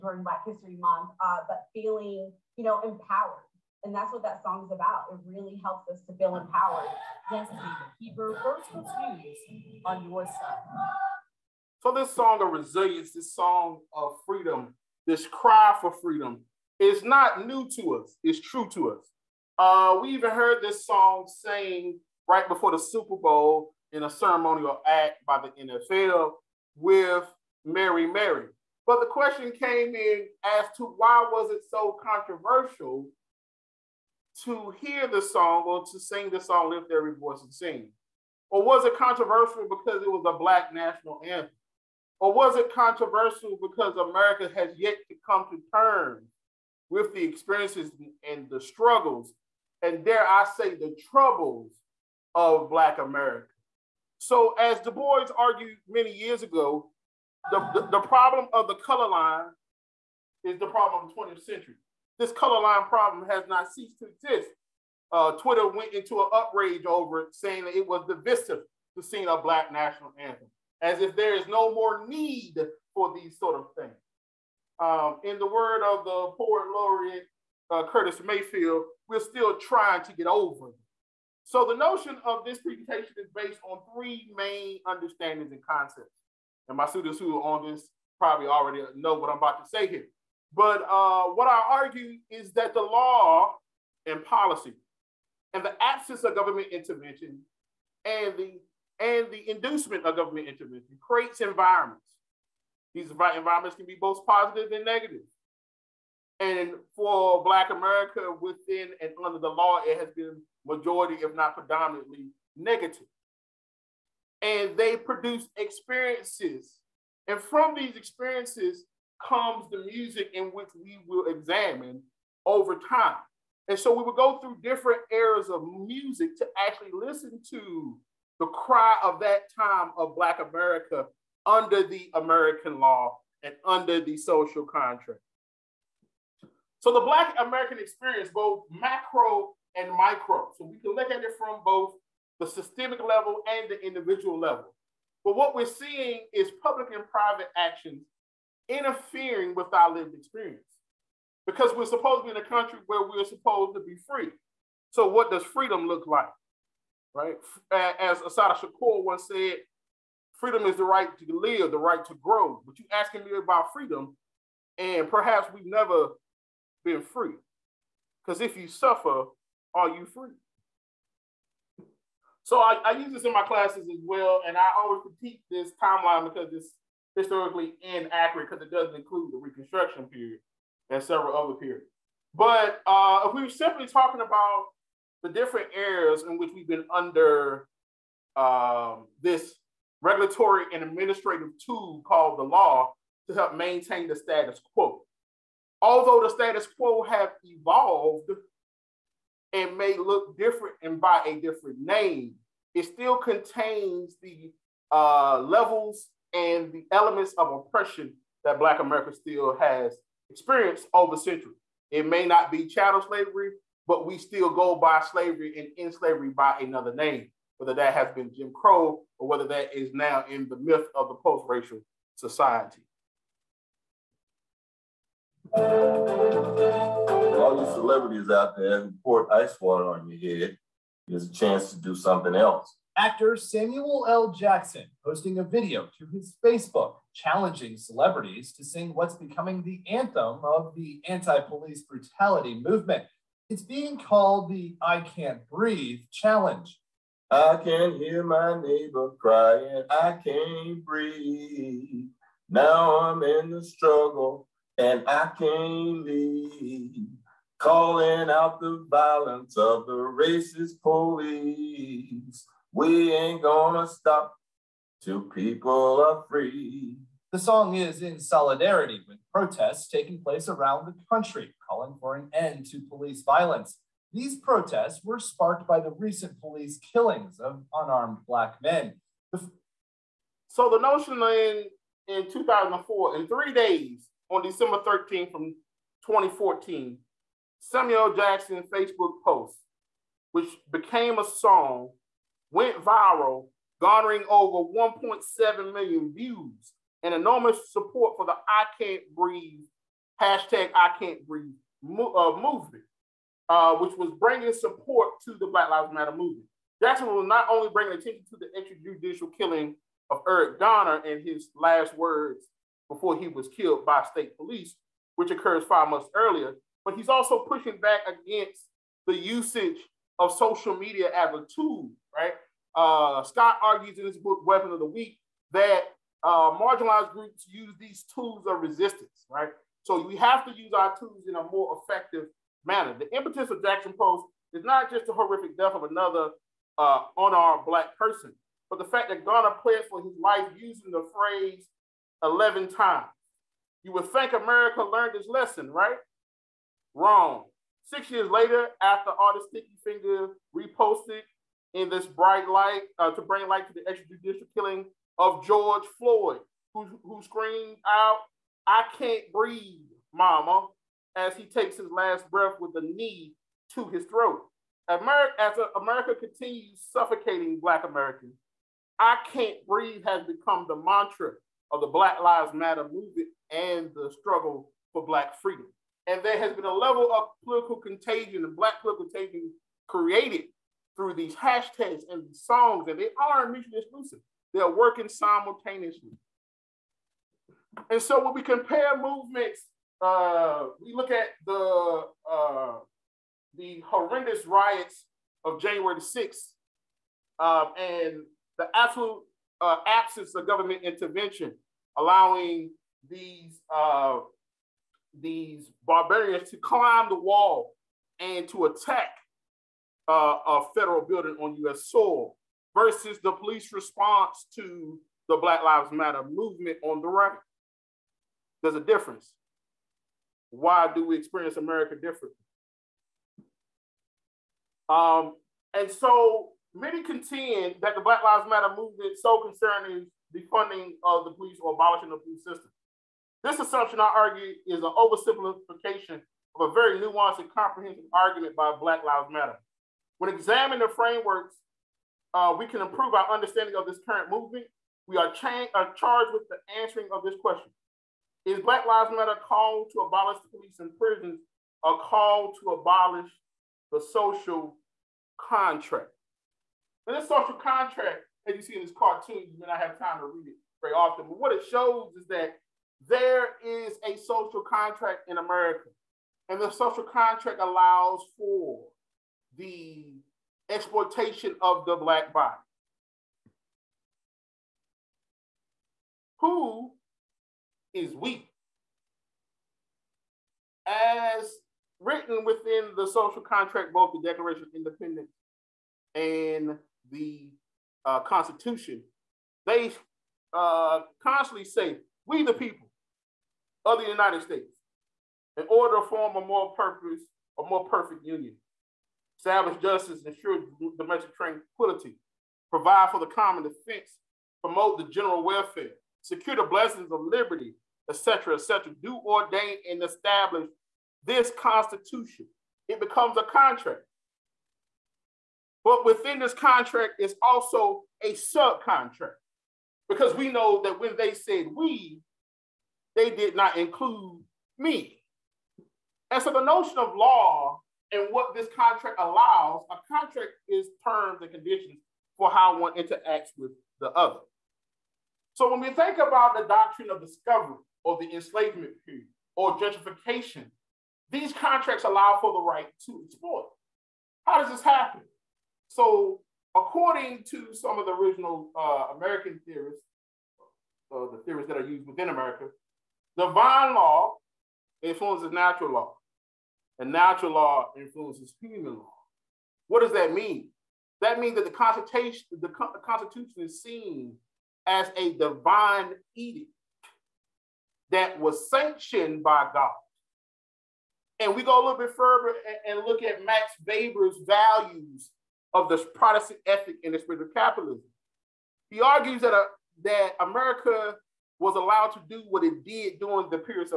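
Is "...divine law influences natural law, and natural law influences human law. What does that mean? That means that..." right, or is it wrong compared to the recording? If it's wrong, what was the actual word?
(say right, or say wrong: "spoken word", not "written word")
right.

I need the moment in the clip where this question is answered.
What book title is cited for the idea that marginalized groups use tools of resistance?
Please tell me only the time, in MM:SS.
05:24.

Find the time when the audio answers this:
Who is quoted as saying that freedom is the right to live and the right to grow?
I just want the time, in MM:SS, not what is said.
02:38.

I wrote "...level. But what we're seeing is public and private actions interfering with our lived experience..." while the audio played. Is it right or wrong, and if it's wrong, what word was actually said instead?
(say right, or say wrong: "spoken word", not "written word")
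right.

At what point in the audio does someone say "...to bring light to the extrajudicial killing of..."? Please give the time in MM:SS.
05:53.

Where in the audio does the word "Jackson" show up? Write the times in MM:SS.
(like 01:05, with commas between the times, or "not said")
03:54, 04:48, 05:06, 05:33.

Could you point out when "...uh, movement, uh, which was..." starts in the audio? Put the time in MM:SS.
05:02.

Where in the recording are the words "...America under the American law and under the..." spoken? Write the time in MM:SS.
02:10.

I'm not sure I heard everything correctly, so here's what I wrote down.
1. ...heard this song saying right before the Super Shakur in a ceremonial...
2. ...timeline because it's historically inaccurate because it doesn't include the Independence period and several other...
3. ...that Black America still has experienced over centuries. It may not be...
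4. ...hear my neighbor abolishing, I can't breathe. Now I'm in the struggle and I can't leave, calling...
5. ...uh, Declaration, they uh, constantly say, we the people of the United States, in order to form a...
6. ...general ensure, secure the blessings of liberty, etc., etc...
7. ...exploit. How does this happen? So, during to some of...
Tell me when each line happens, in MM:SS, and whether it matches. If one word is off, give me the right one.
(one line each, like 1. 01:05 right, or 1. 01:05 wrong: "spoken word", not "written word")
1. 00:20 wrong: "Bowl", not "Shakur"
2. 02:55 wrong: "Reconstruction", not "Independence"
3. 03:28 right
4. 04:07 wrong: "crying", not "abolishing"
5. 08:08 wrong: "Constitution", not "Declaration"
6. 08:25 wrong: "welfare", not "ensure"
7. 09:03 wrong: "according", not "during".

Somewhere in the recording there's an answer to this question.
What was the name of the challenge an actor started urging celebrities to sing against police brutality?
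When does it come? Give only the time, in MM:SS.
04:04.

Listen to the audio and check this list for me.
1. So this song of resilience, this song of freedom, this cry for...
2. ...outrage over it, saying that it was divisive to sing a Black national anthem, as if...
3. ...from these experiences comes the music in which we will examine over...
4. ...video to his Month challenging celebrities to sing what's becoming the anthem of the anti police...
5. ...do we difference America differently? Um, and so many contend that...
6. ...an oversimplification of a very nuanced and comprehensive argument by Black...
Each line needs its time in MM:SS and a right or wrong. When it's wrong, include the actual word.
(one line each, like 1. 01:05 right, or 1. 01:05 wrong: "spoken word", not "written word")
1. 00:11 right
2. 01:06 right
3. 01:57 right
4. 03:55 wrong: "Facebook", not "Month"
5. 07:00 wrong: "experience", not "difference"
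6. 07:14 right.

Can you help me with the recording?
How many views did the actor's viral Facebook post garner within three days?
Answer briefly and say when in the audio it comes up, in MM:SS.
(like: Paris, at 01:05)
1.7 million, at 04:54.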